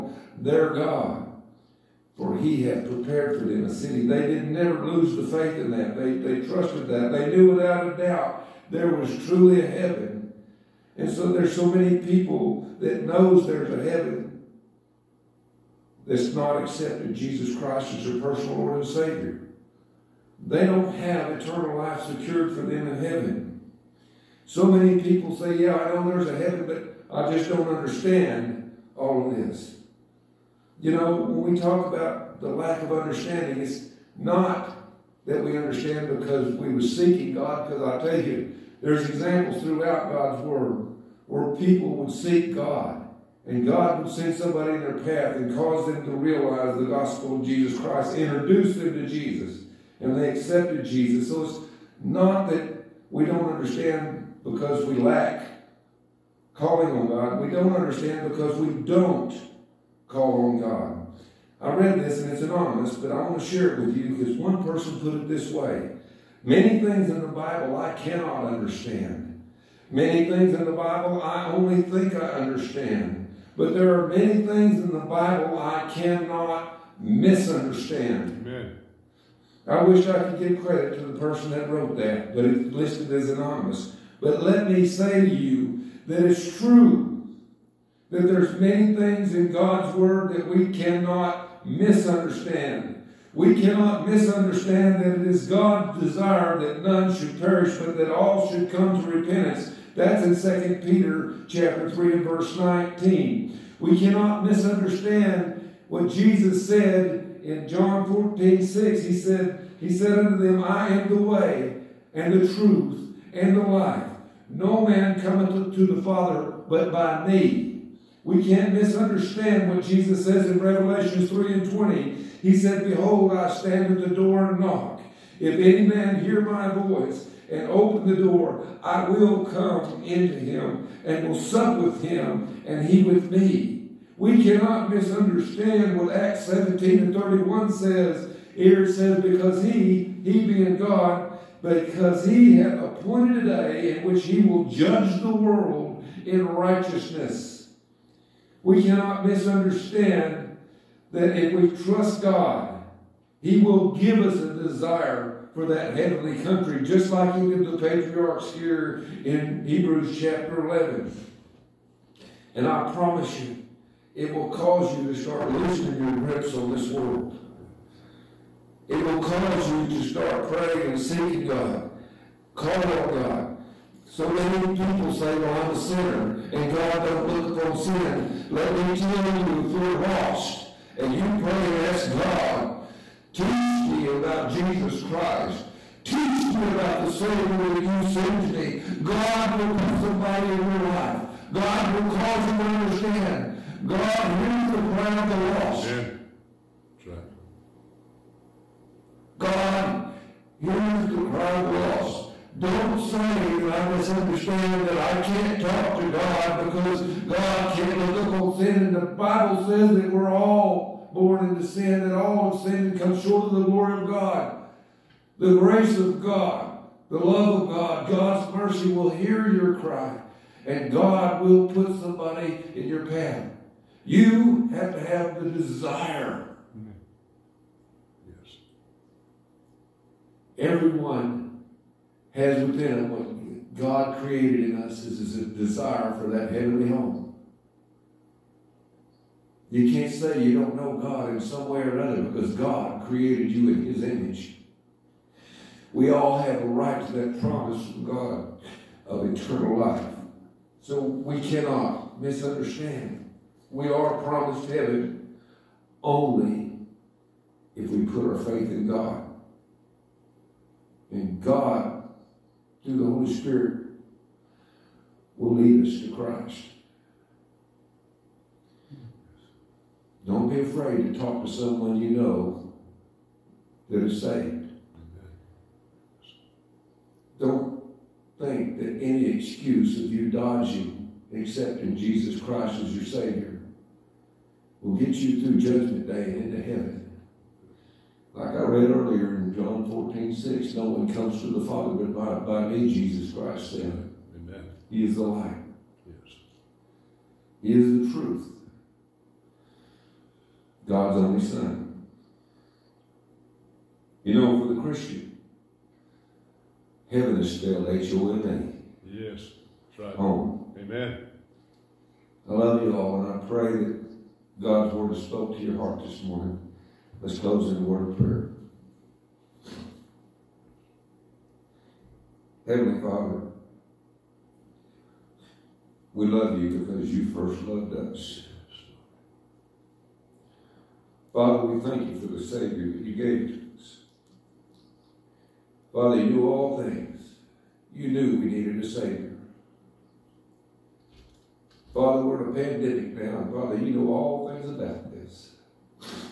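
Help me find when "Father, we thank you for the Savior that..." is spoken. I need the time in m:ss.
5:31.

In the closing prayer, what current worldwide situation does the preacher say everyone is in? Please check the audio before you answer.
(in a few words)
A pandemic.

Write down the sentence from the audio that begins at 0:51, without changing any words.
So it's not that we don't understand because we lack calling on God, we don't understand because we don't call on God.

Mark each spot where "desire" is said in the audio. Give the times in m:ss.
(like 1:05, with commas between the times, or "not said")
1:35, 2:34, 3:45, 3:55.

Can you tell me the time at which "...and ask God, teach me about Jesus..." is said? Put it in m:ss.
3:01.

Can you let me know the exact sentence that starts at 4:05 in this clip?
We all have a right to that promise from God of eternal life.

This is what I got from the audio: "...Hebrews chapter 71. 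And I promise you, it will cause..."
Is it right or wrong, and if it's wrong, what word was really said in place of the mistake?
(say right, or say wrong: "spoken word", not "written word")
wrong: "11", not "71".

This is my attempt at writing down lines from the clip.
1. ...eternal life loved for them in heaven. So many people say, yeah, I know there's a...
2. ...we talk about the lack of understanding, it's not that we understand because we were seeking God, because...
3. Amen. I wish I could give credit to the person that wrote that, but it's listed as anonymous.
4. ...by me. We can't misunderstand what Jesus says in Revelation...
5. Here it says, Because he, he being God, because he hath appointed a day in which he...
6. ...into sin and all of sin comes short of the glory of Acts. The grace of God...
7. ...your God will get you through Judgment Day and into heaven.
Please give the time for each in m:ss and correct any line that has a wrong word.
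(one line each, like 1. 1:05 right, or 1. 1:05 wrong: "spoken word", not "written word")
1. 0:21 wrong: "secured", not "loved"
2. 0:31 right
3. 1:18 right
4. 1:56 right
5. 2:18 right
6. 3:31 wrong: "God", not "Acts"
7. 4:42 wrong: "Savior", not "God".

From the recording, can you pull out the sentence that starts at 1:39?
That's in 2 Peter chapter 3 and verse 19.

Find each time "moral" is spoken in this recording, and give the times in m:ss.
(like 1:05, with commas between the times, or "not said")
not said.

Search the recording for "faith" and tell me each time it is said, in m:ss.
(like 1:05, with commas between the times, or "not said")
0:05, 4:18.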